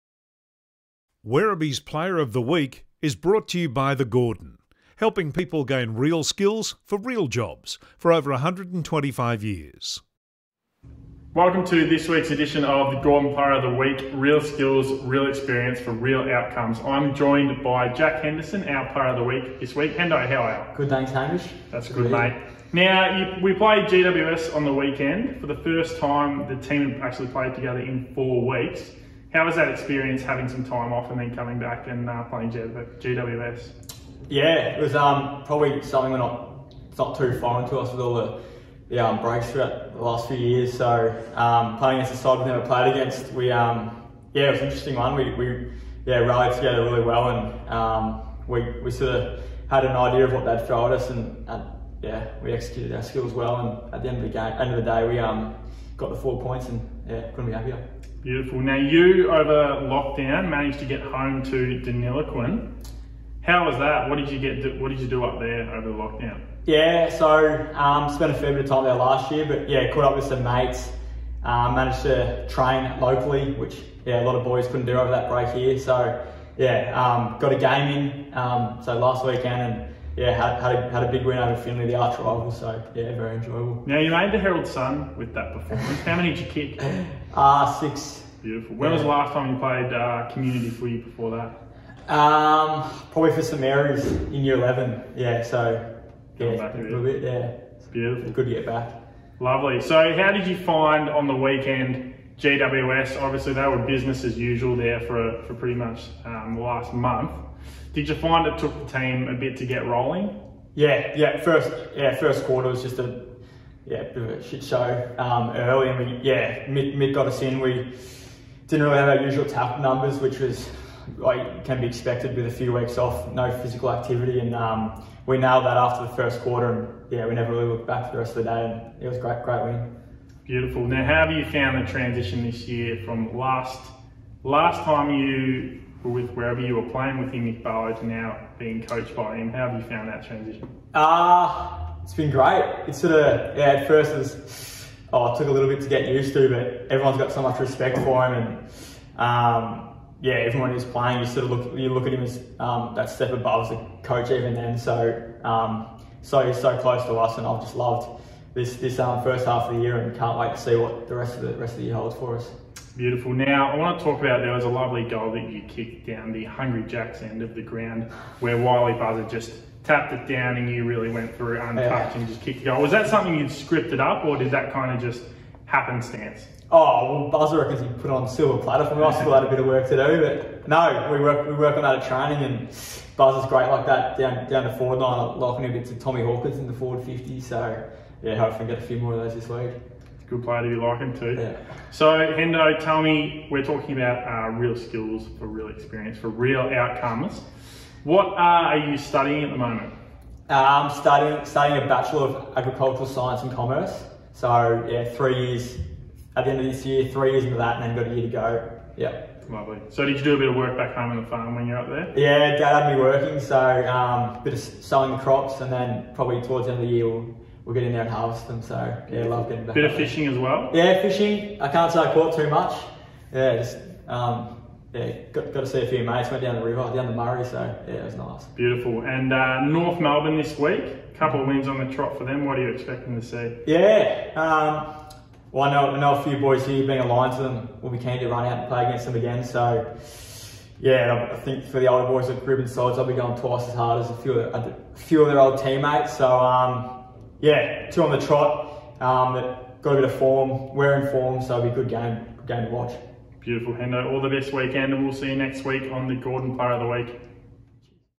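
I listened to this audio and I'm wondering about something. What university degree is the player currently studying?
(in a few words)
Bachelor of Agricultural Science and Commerce.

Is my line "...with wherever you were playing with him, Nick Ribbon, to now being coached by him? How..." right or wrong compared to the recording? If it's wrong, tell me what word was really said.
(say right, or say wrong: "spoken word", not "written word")
wrong: "Barlow", not "Ribbon".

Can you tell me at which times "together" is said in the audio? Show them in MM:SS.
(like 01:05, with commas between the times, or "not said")
00:27, 00:46.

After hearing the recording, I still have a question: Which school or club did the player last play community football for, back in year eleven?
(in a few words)
St Mary's.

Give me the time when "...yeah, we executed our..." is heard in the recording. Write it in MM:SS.
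00:52.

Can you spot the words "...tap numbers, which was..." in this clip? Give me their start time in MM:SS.
01:59.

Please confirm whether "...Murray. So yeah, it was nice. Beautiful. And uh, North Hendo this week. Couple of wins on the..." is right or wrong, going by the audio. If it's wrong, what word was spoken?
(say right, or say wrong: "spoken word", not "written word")
wrong: "Melbourne", not "Hendo".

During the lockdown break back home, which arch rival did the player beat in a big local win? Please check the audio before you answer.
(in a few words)
Finley.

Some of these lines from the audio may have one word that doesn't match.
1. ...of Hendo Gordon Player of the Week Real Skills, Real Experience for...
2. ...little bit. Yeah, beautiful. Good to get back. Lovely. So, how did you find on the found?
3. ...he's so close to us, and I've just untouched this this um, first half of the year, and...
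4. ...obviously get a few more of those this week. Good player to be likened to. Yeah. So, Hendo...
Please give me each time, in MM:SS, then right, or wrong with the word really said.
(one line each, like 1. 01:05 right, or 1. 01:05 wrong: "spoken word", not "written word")
1. 00:12 wrong: "The", not "Hendo"
2. 01:36 wrong: "weekend", not "found"
3. 02:36 wrong: "loved", not "untouched"
4. 03:08 wrong: "hopefully", not "obviously".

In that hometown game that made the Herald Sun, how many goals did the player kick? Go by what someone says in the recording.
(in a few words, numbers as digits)
6.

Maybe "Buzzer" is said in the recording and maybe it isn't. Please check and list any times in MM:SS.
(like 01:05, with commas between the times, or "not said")
02:48, 02:57, 03:03.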